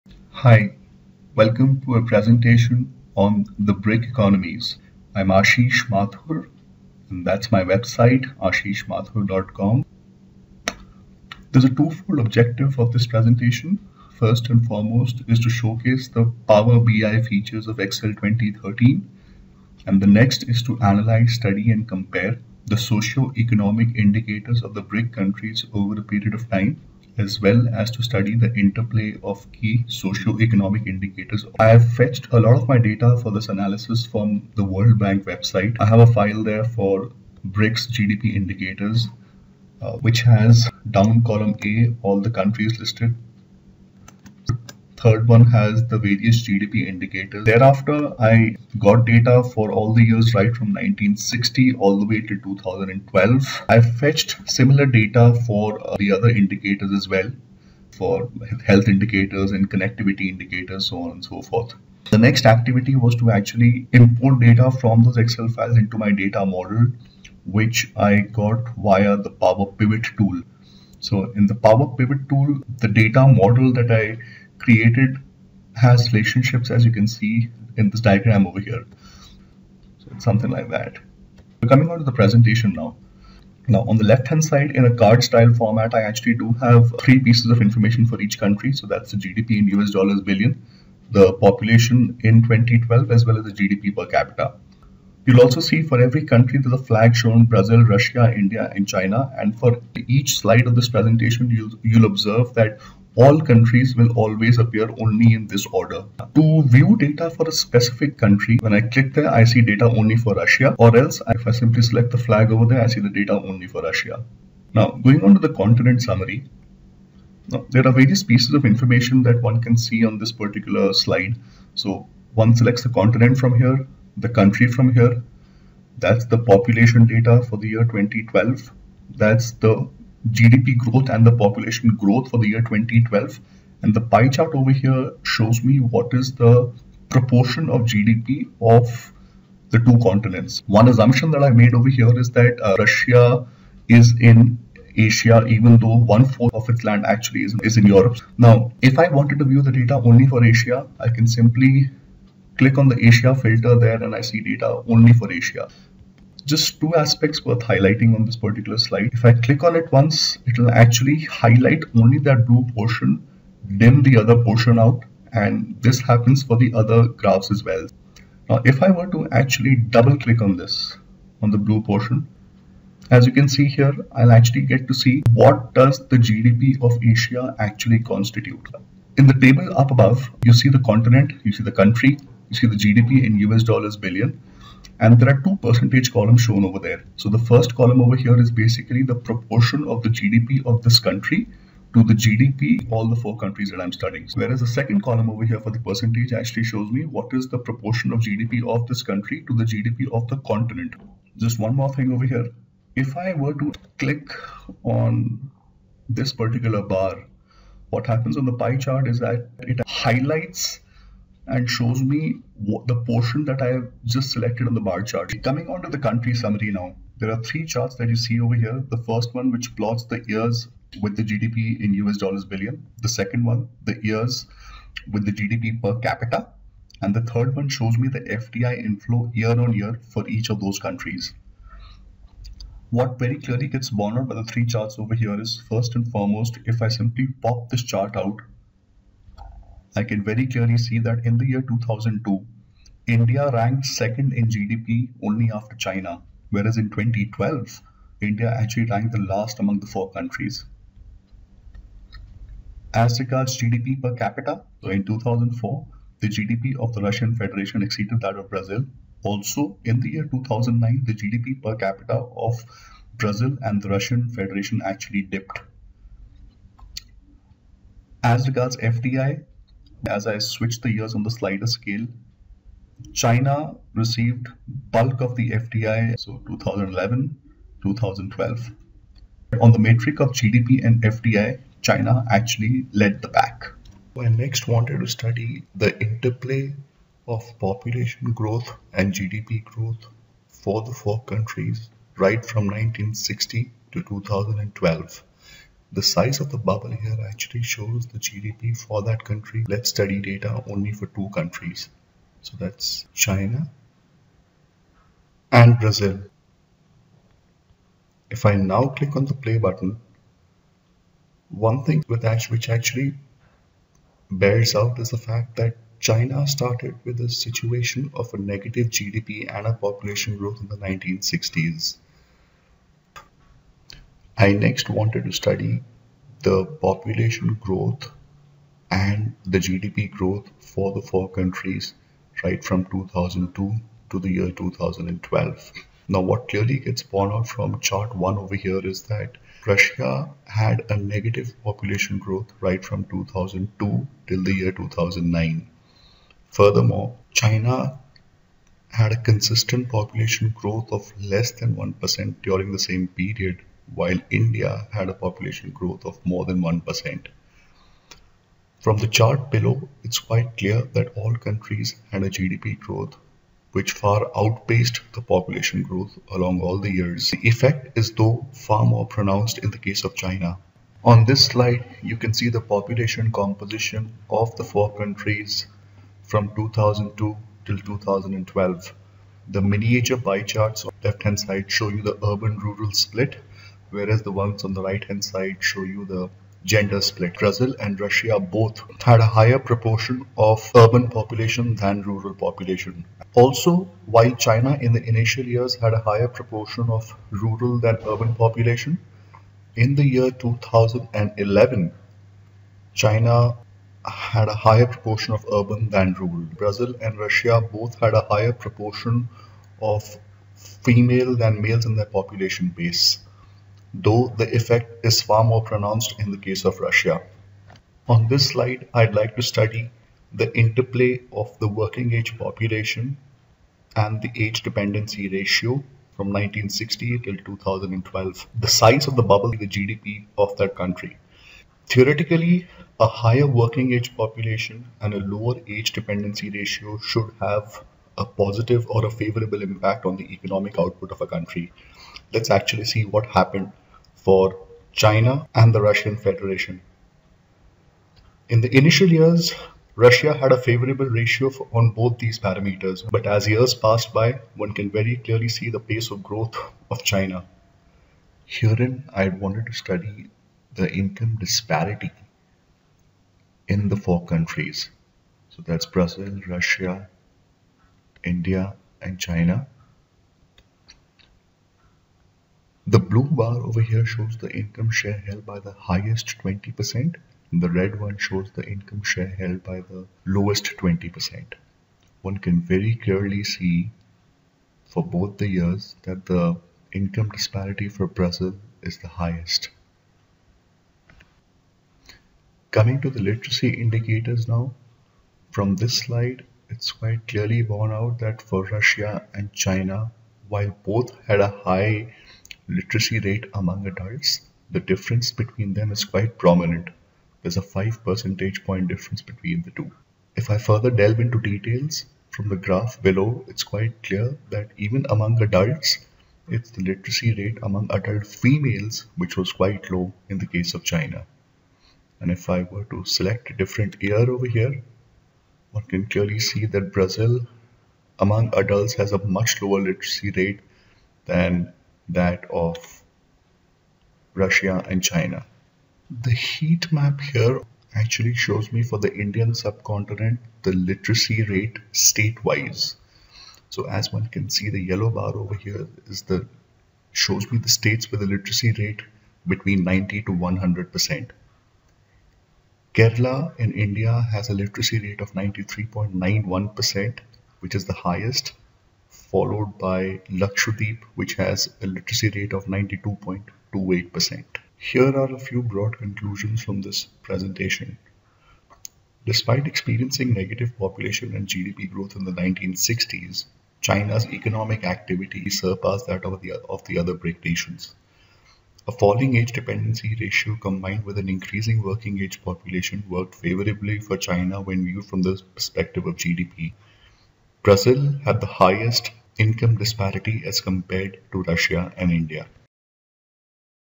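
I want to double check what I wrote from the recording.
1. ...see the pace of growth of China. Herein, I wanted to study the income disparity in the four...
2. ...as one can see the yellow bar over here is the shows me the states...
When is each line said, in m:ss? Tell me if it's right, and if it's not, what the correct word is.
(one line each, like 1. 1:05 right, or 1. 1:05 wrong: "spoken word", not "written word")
1. 7:35 right
2. 9:03 right.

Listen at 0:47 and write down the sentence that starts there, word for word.
Thereafter, I got data for all the years right from 1960 all the way till 2012.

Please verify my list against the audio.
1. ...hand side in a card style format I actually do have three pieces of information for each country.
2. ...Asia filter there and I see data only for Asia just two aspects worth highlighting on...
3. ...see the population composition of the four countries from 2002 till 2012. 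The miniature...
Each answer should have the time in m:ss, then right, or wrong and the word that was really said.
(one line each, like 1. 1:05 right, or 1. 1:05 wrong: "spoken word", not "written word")
1. 1:24 right
2. 2:33 right
3. 6:12 right.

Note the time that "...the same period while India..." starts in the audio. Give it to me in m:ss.
5:52.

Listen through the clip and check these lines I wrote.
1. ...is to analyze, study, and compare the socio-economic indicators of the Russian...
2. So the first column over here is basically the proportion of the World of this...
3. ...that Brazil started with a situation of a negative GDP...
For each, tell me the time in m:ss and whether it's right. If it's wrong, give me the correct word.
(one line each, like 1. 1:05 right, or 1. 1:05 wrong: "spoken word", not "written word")
1. 0:20 wrong: "BRIC", not "Russian"
2. 3:07 wrong: "GDP", not "World"
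3. 5:15 wrong: "China", not "Brazil".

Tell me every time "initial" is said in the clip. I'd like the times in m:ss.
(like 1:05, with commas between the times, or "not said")
6:35, 7:28.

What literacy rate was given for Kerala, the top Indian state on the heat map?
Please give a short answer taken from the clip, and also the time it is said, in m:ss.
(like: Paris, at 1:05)
93.91%, at 9:15.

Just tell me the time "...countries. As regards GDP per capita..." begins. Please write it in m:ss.
4:10.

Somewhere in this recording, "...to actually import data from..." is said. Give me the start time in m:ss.
1:03.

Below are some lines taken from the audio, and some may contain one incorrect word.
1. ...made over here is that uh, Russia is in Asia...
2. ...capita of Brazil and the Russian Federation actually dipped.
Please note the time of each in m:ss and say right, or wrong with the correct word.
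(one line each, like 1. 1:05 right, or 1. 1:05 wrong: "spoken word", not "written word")
1. 2:21 right
2. 4:21 right.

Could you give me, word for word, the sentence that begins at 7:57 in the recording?
The red one shows the income share held by the lowest 20%.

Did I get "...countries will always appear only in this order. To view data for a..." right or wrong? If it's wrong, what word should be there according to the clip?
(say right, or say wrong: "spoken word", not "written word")
right.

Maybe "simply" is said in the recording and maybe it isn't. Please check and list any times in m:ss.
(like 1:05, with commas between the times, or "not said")
1:51, 2:31, 3:56.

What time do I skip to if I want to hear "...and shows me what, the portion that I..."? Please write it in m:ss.
3:31.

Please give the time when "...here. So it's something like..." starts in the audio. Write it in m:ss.
1:18.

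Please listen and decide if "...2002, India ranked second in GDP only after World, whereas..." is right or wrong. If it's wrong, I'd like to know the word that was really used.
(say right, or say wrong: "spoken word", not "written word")
wrong: "China", not "World".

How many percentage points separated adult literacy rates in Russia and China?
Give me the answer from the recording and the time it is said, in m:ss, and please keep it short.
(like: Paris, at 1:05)
5, at 8:27.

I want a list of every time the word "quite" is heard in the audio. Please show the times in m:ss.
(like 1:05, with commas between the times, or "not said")
6:00, 8:16, 8:26, 8:33, 8:39.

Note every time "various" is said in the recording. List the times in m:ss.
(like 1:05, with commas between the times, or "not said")
0:45, 1:57.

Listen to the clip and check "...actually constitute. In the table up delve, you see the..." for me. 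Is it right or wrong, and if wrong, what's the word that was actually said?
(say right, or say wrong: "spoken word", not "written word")
wrong: "above", not "delve".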